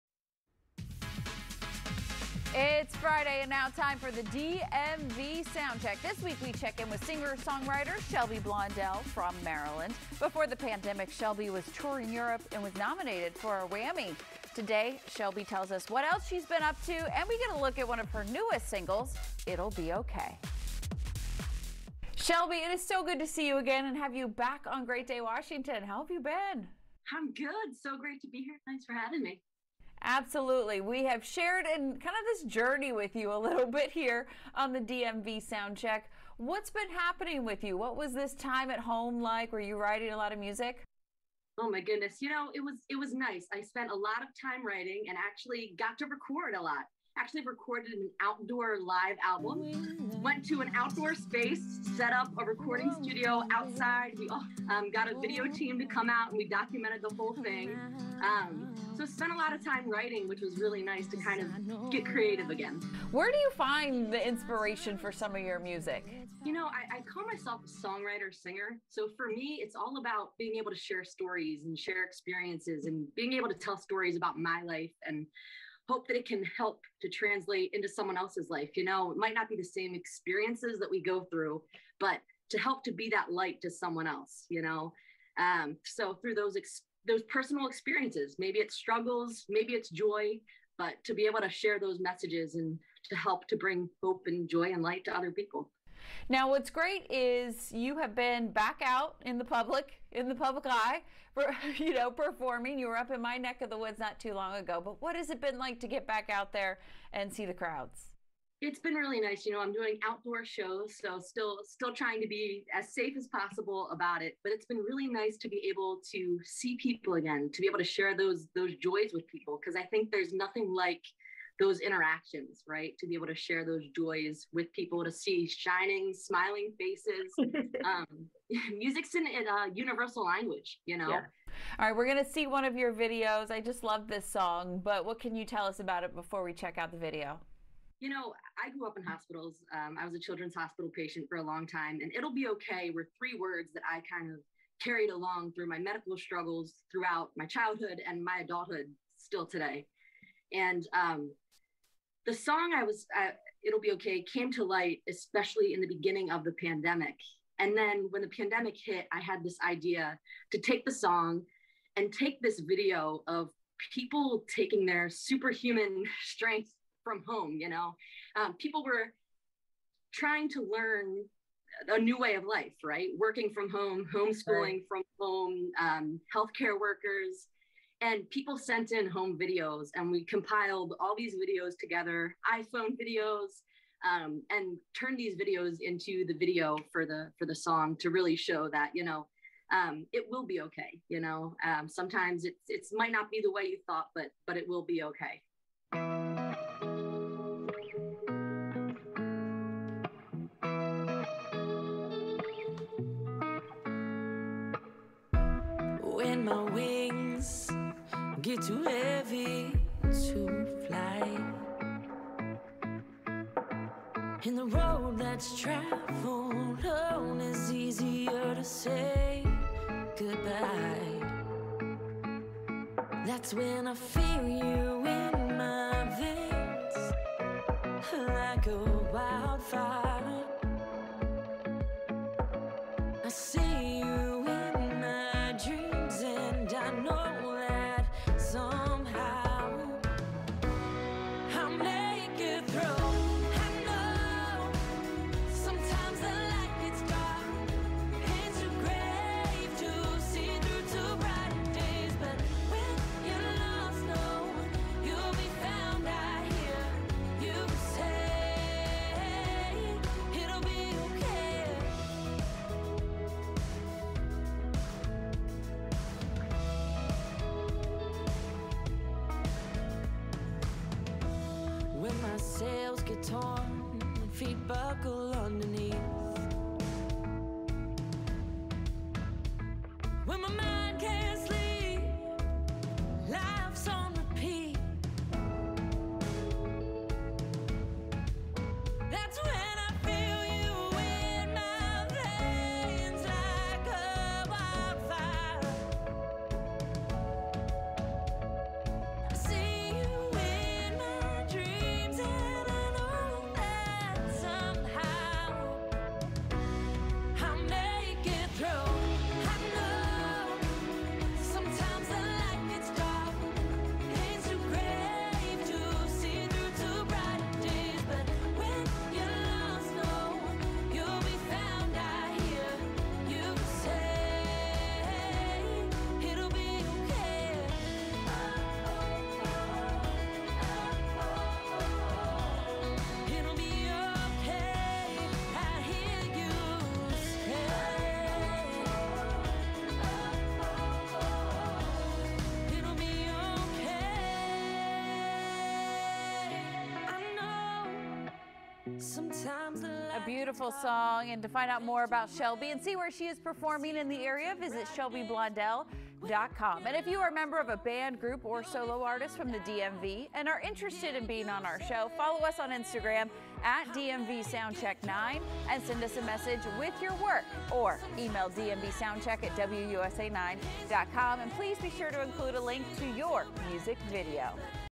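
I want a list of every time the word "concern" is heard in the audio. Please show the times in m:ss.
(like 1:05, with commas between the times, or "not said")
not said.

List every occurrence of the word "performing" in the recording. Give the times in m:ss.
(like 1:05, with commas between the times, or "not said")
1:42, 5:53.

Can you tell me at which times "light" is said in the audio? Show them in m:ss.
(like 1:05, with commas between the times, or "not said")
1:23, 1:34, 2:34.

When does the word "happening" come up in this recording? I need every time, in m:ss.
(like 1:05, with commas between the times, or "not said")
0:36.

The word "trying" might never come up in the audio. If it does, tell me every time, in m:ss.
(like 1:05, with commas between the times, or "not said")
1:51, 2:50.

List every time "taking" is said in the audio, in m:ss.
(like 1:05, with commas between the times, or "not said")
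2:44.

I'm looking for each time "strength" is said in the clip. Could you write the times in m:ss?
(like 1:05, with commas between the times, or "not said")
2:46.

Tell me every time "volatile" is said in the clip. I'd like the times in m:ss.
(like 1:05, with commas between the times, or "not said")
not said.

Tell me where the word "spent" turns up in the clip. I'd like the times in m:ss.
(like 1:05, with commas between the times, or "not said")
0:43, 0:59.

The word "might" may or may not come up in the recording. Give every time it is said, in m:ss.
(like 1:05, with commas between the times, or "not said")
1:19, 3:12.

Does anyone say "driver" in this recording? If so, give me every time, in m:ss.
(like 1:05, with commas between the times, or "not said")
not said.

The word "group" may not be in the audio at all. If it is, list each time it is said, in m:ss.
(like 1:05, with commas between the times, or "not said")
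5:58.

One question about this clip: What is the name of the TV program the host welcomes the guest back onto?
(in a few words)
Great Day Washington.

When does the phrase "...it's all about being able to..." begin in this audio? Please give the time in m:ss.
1:09.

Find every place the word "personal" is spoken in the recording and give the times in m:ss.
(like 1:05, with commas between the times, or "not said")
1:27.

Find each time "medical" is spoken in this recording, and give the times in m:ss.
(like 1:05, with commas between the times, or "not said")
2:25.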